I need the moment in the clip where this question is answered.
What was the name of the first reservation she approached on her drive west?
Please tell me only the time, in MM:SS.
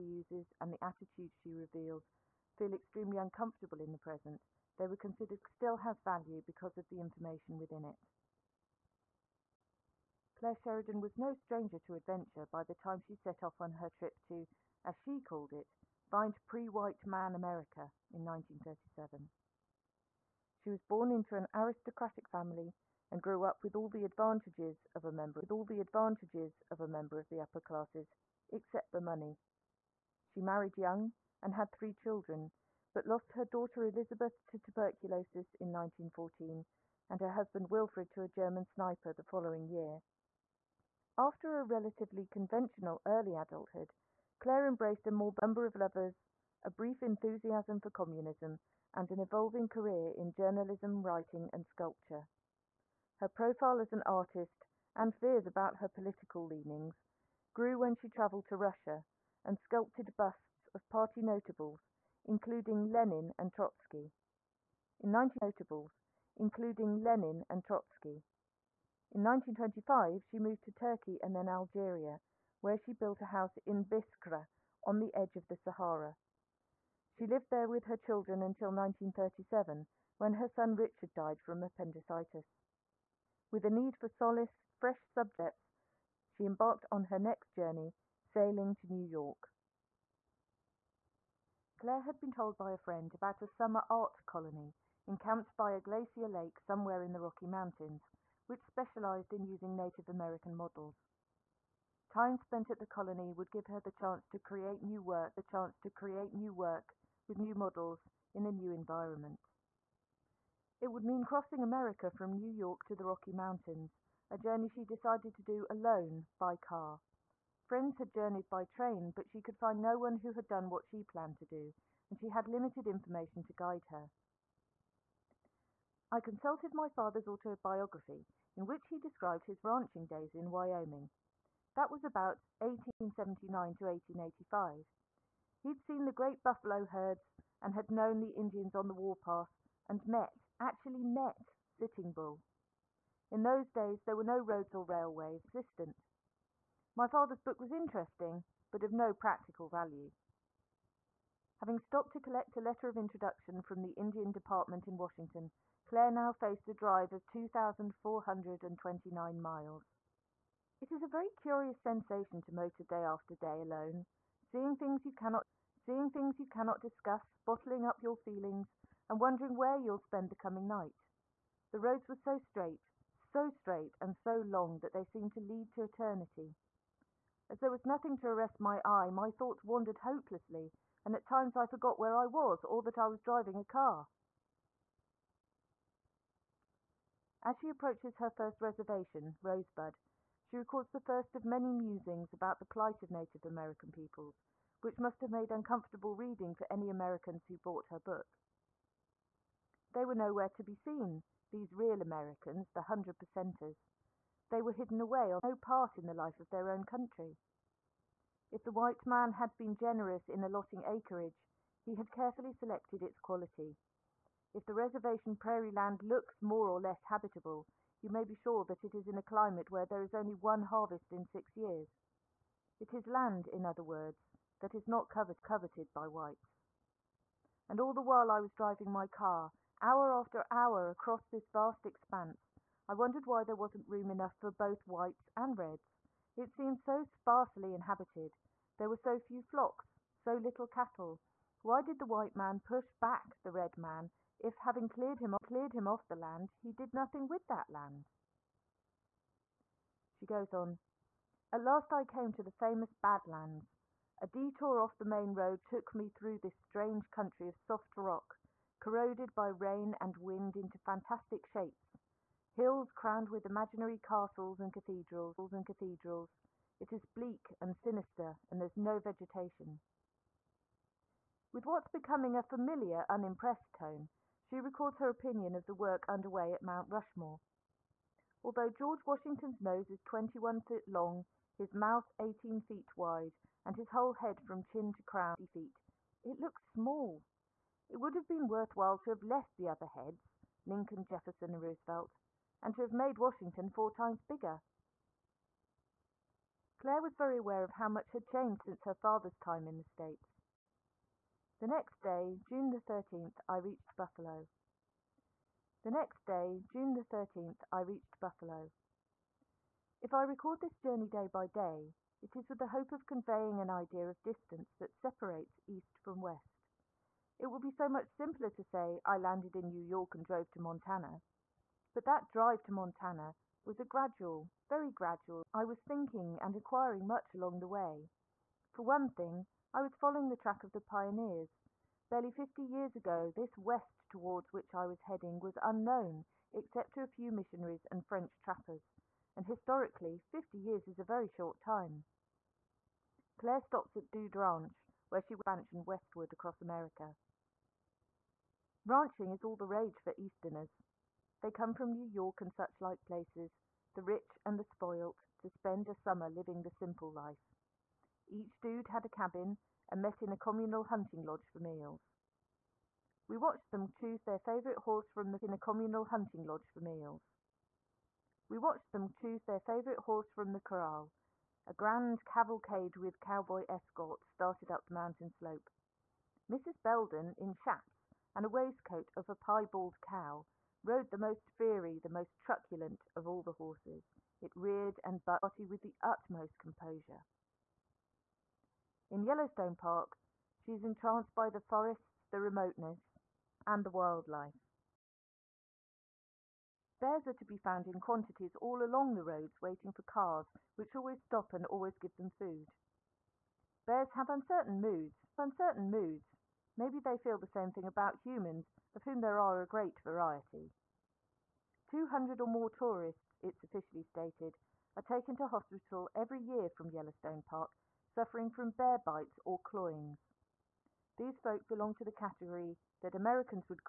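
03:09.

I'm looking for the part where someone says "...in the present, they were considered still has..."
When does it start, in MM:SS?
00:03.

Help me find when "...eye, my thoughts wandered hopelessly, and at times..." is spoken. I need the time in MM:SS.
02:58.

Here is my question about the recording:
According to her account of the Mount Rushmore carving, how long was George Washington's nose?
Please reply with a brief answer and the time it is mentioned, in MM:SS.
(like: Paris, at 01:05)
21 feet, at 04:39.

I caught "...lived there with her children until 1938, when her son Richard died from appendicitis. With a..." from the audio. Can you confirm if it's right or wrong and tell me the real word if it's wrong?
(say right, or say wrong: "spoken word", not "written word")
wrong: "1937", not "1938".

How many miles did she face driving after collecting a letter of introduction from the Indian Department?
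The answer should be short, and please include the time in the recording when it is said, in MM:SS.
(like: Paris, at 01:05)
2,429, at 02:37.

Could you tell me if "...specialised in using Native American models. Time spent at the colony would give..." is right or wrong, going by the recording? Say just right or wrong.
right.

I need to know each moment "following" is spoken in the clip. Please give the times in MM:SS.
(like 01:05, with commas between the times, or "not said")
00:39, 05:29.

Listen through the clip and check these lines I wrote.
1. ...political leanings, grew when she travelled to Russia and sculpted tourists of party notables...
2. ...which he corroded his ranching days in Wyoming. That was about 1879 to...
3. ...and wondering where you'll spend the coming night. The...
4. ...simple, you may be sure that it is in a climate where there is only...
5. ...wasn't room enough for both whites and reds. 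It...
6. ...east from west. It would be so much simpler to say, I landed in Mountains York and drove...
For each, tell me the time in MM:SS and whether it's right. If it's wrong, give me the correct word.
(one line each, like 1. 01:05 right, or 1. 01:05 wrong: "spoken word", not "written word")
1. 00:55 wrong: "busts", not "tourists"
2. 02:08 wrong: "described", not "corroded"
3. 02:49 right
4. 03:37 wrong: "habitable", not "simple"
5. 03:53 right
6. 05:15 wrong: "New", not "Mountains".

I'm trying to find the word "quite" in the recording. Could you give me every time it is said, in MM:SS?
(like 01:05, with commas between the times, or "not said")
not said.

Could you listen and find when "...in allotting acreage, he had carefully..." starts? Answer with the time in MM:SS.
03:30.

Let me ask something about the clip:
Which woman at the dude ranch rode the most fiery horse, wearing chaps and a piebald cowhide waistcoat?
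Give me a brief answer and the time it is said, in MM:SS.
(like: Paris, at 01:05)
Mrs. Belden, at 06:16.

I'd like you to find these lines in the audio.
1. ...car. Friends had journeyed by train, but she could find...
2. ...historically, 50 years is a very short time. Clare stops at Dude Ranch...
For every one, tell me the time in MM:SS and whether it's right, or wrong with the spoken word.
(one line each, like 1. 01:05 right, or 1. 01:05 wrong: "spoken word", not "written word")
1. 01:56 right
2. 05:39 right.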